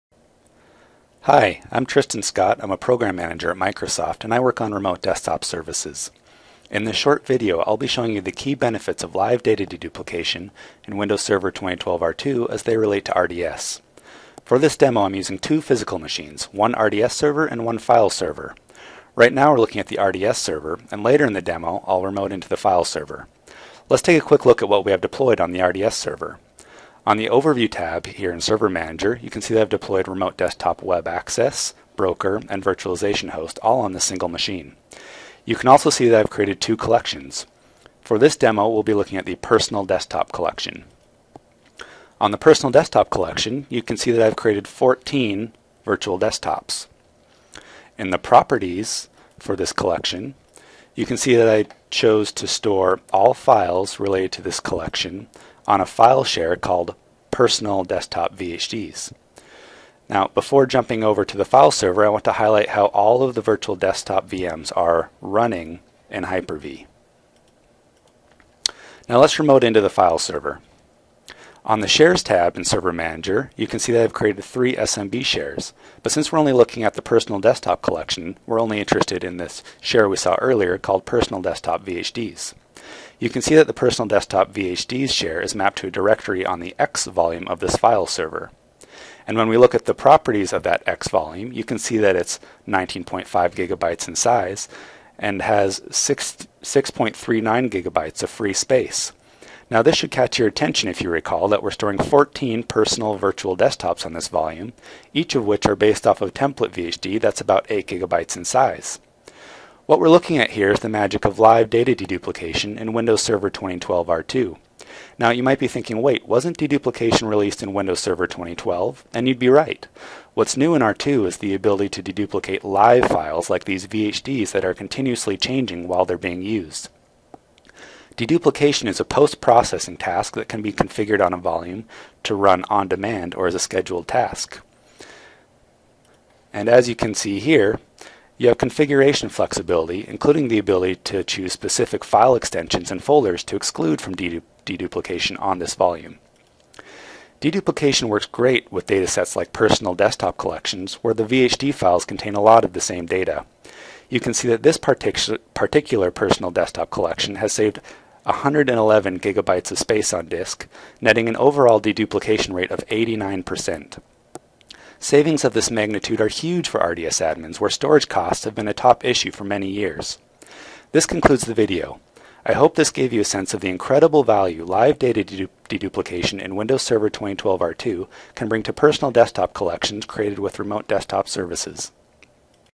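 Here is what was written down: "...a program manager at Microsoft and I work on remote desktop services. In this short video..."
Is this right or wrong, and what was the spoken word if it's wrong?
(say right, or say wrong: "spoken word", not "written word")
right.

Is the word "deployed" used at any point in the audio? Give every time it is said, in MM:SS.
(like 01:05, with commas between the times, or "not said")
00:25, 00:29.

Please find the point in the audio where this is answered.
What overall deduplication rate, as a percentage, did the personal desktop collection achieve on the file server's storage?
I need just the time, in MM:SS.
02:42.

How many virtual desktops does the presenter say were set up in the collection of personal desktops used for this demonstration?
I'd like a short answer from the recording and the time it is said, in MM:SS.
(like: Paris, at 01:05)
14, at 00:44.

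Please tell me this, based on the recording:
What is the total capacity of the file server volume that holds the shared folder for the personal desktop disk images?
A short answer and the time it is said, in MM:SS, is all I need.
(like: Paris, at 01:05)
19.5 gigabytes, at 01:32.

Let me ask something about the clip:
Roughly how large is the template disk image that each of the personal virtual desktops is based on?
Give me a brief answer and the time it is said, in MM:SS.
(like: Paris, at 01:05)
8 gigabytes, at 01:47.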